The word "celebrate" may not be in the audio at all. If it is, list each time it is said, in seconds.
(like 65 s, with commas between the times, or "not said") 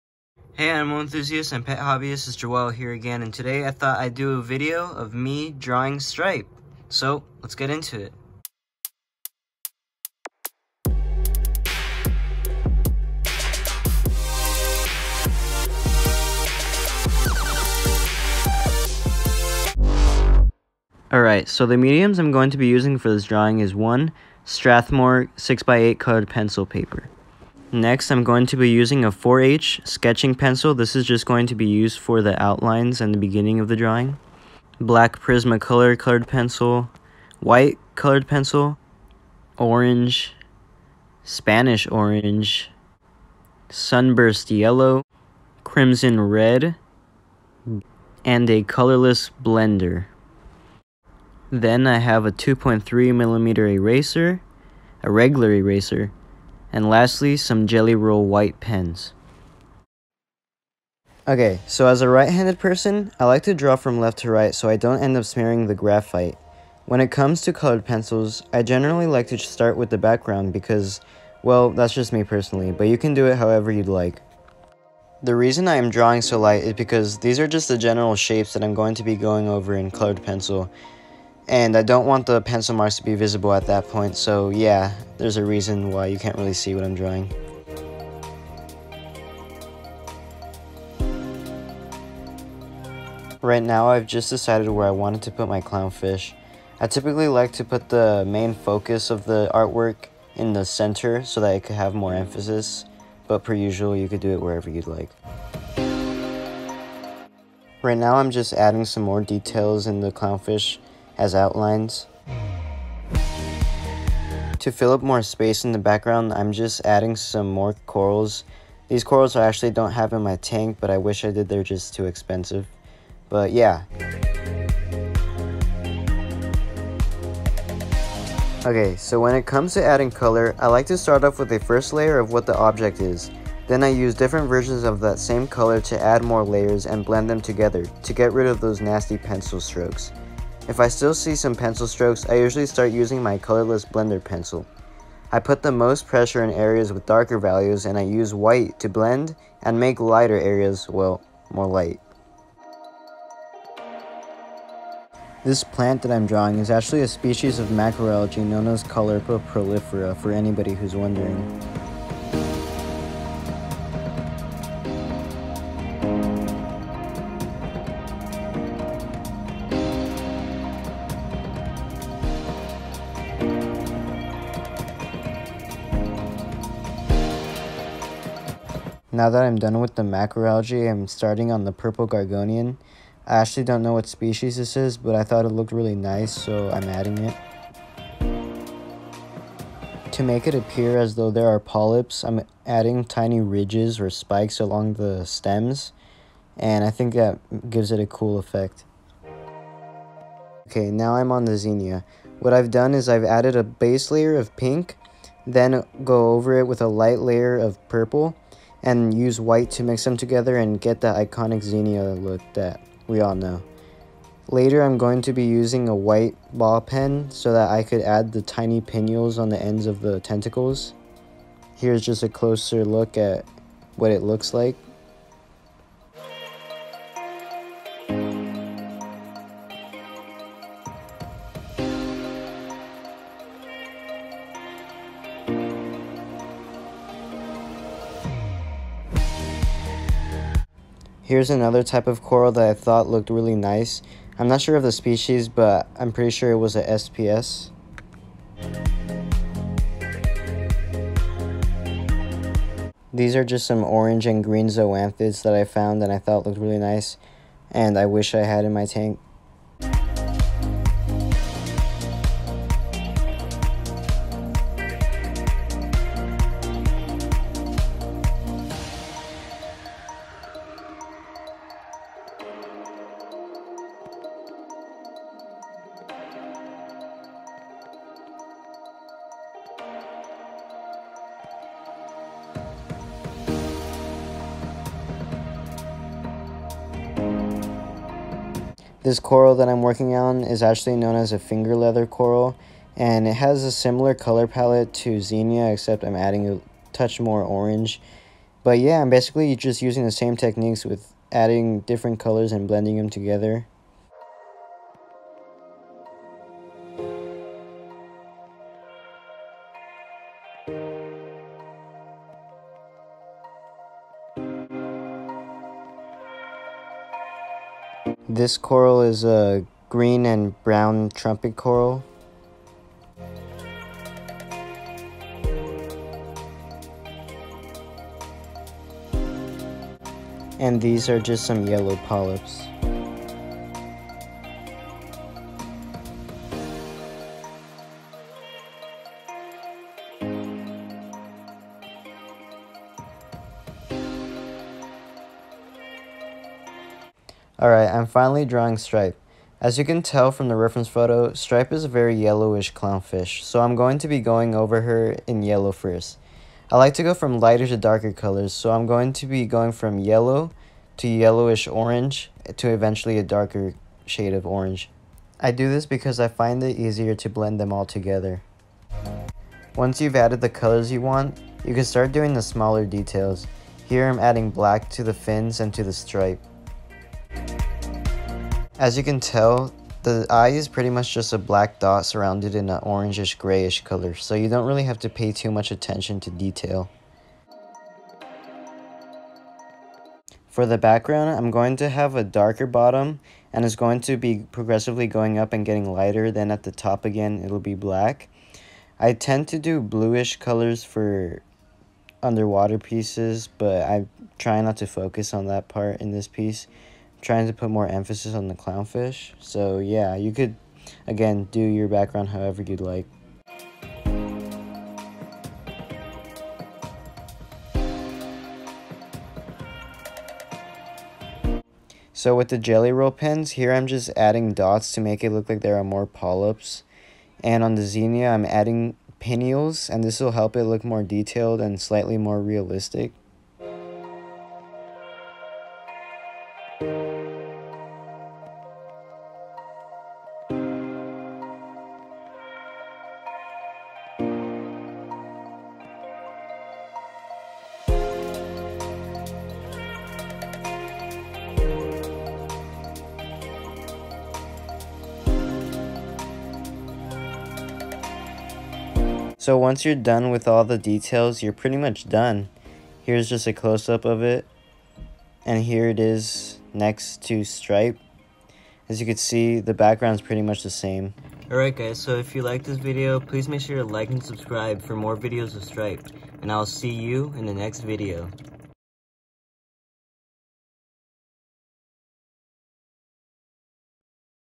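not said.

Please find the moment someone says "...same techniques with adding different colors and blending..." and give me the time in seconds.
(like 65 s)
300 s.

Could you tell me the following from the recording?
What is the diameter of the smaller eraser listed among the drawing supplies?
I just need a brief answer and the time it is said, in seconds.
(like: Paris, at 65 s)
2.3 millimeter, at 52 s.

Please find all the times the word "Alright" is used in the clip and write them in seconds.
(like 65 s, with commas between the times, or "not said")
21 s, 347 s, 471 s.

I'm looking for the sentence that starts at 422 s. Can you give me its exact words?
So with the jelly roll pens, here I'm just adding dots to make it look like there are more polyps.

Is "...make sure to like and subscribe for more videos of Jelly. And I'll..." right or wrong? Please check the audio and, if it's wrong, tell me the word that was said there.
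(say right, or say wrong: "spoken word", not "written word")
wrong: "Stripe", not "Jelly".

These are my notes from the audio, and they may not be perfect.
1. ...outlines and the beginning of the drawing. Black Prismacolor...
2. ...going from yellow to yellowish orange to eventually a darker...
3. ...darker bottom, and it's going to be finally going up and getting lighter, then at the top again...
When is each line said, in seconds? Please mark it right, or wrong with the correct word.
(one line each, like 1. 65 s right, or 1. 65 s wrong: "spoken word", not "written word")
1. 32 s right
2. 359 s right
3. 392 s wrong: "progressively", not "finally".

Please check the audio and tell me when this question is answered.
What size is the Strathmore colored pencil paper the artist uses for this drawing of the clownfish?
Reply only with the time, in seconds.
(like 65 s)
25 s.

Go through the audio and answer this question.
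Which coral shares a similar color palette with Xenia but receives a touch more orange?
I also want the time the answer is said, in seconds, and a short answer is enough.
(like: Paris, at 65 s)
Finger leather coral, at 291 s.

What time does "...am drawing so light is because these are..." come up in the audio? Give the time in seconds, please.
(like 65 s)
75 s.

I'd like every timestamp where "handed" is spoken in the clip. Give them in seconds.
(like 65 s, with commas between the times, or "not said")
62 s.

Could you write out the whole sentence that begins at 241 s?
Here's another type of coral that I thought looked really nice.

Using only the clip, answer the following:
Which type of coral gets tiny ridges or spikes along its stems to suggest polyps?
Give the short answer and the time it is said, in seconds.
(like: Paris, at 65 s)
Purple gorgonian, at 181 s.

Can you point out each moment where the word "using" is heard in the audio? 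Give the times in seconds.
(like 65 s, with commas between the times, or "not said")
22 s, 28 s, 142 s, 215 s, 299 s.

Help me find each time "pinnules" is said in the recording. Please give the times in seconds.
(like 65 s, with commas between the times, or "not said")
218 s, 429 s.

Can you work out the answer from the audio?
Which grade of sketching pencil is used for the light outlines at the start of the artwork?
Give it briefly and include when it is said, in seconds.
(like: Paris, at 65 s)
4H, at 29 s.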